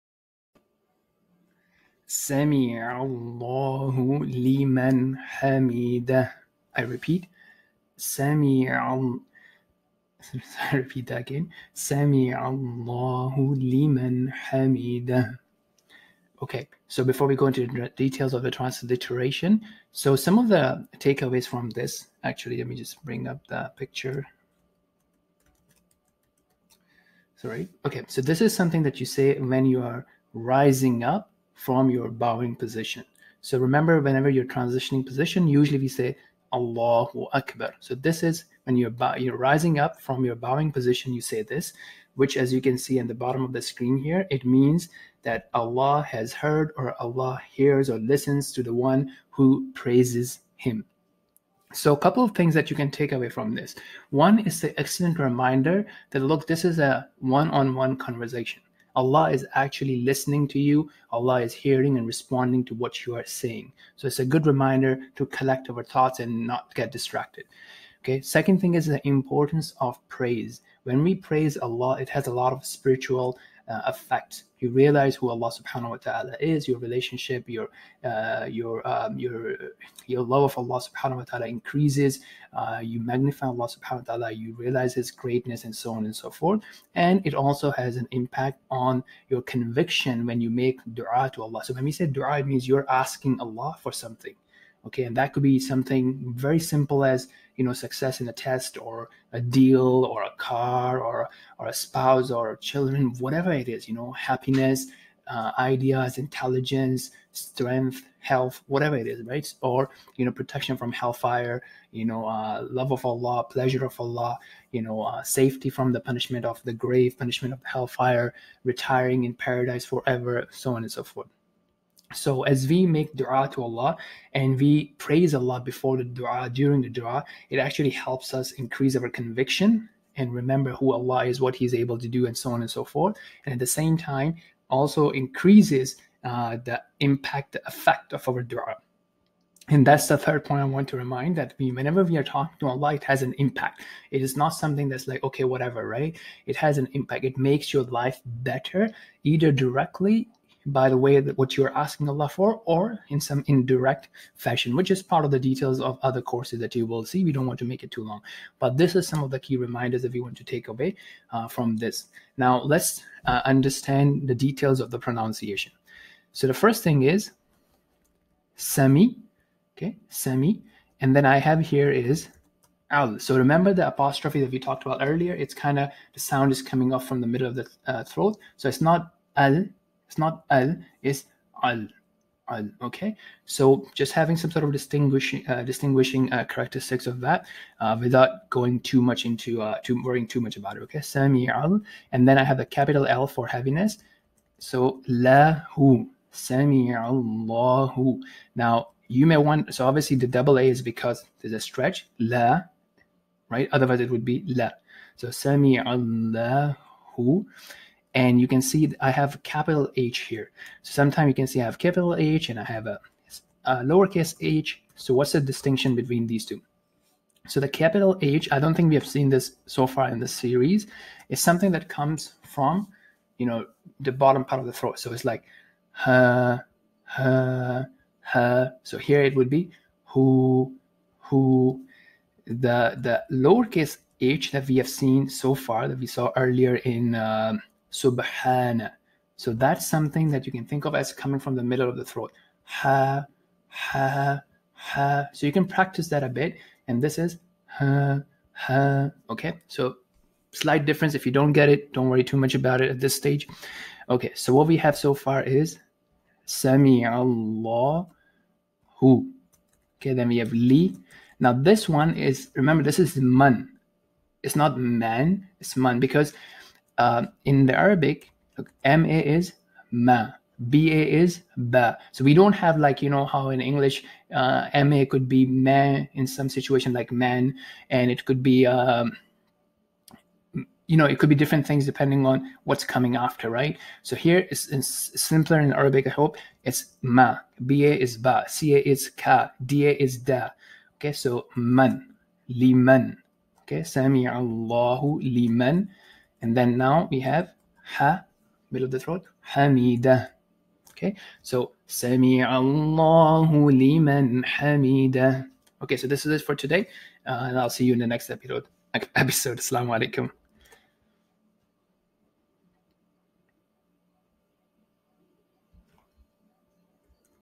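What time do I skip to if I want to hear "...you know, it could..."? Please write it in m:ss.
4:40.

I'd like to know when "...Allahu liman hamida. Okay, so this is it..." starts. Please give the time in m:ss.
5:02.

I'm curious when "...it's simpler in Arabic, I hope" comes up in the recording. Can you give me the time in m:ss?
4:44.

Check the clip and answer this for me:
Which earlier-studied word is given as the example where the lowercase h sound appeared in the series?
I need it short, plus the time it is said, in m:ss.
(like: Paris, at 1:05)
subhana, at 3:57.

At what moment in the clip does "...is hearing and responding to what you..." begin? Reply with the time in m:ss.
1:01.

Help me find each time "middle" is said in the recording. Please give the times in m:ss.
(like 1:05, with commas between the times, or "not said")
2:57, 4:01, 4:58.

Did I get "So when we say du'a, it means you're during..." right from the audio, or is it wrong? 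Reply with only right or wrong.
wrong.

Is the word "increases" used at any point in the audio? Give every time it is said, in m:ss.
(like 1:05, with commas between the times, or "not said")
1:21, 2:08, 2:15.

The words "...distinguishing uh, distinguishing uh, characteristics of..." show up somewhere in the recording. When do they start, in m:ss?
3:04.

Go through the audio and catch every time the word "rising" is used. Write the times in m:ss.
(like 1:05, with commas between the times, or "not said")
0:30, 0:39.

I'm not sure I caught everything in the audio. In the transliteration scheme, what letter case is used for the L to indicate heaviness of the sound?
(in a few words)
capital L.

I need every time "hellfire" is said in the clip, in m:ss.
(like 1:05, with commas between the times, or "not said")
1:50, 1:57.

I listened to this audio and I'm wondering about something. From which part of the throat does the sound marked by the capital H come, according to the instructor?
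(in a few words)
bottom part of the throat.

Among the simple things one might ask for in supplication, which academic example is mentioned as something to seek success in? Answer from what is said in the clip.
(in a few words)
a test.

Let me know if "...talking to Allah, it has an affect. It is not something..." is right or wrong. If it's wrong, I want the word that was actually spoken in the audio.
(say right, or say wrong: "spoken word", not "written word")
wrong: "impact", not "affect".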